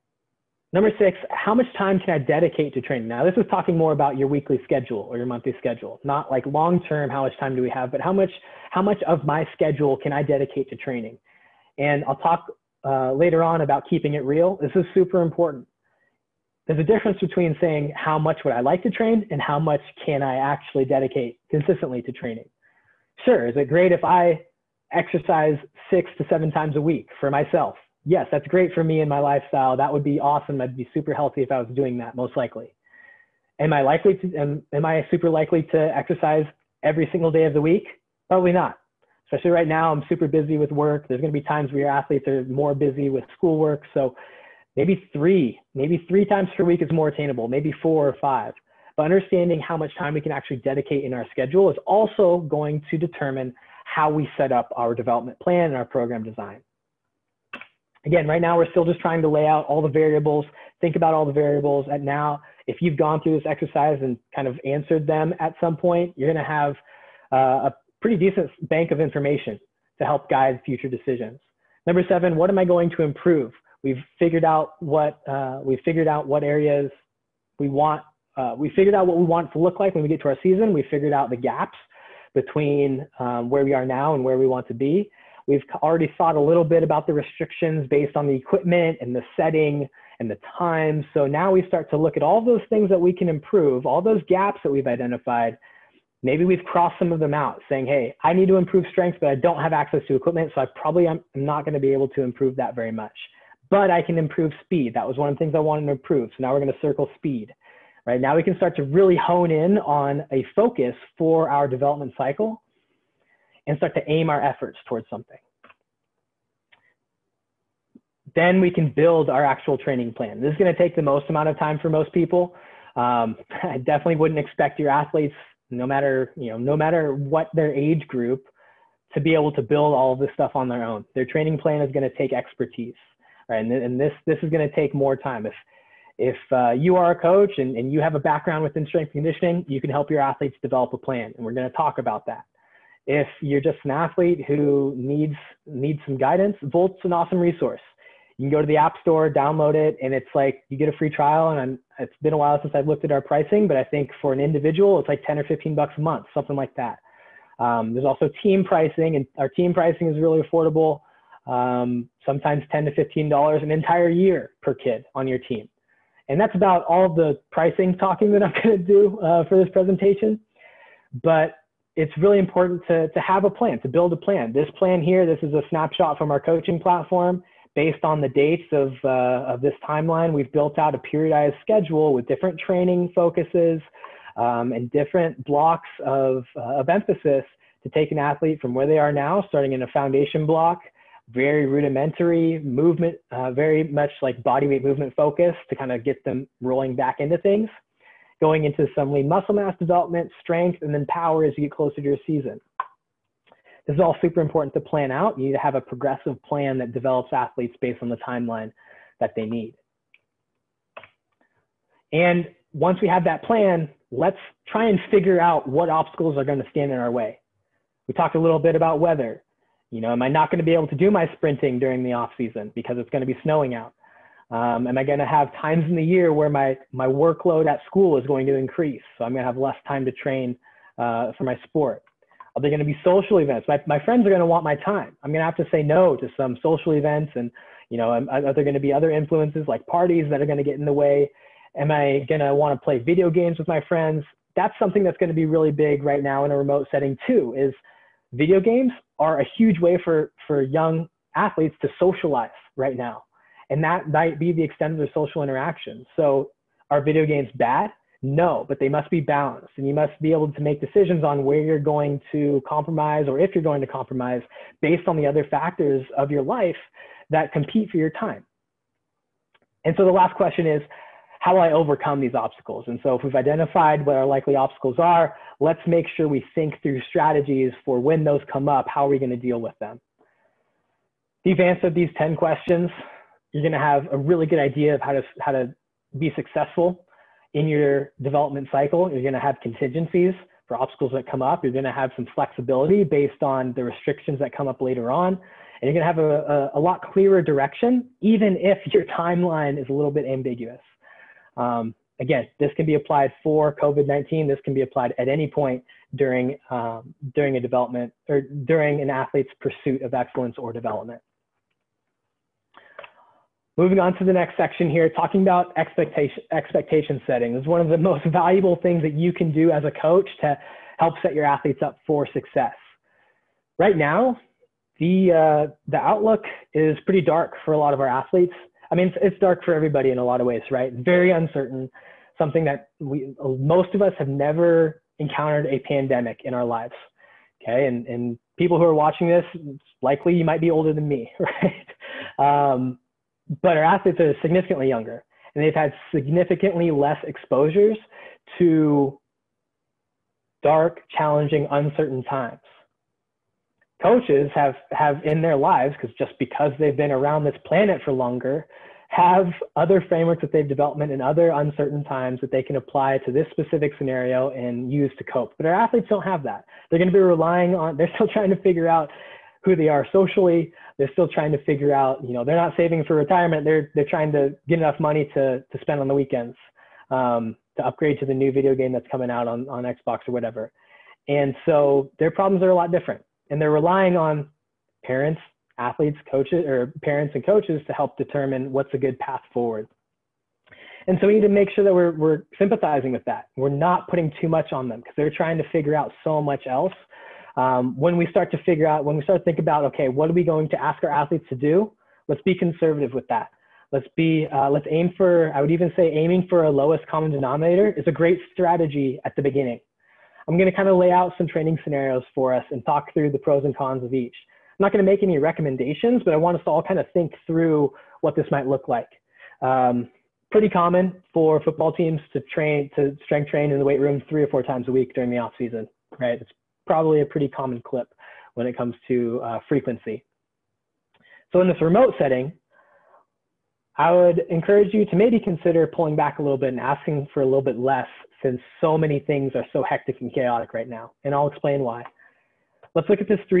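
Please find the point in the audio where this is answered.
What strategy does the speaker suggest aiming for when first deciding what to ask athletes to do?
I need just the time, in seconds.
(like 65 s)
406 s.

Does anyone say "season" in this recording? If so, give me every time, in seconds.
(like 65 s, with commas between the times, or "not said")
80 s, 202 s, 222 s, 425 s.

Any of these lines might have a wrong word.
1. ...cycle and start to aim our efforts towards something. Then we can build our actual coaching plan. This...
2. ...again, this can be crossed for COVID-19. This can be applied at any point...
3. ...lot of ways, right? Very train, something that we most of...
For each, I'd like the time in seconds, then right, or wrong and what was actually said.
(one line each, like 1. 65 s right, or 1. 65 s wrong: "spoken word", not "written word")
1. 112 s wrong: "training", not "coaching"
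2. 302 s wrong: "applied", not "crossed"
3. 330 s wrong: "uncertain", not "train".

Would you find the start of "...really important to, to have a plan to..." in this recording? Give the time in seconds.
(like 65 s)
172 s.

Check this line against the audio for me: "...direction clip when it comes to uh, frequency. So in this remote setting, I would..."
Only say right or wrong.
wrong.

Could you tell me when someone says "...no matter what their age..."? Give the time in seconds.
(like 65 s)
126 s.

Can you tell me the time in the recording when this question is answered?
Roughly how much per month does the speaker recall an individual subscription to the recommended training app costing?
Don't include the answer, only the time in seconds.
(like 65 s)
155 s.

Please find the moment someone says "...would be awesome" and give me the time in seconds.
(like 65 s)
29 s.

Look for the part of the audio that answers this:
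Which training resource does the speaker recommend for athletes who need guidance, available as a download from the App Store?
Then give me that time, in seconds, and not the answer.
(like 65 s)
146 s.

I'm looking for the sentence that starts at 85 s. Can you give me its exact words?
We've already thought a little bit about the restrictions based on the equipment and the setting and the time.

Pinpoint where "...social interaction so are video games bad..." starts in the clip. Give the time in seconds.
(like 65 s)
255 s.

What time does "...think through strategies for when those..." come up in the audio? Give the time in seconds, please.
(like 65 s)
276 s.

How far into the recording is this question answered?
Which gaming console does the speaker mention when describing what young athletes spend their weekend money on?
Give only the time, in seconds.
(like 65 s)
379 s.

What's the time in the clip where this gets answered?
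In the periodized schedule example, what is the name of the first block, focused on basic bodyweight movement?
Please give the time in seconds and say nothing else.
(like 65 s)
189 s.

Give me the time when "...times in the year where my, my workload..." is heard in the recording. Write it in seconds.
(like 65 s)
225 s.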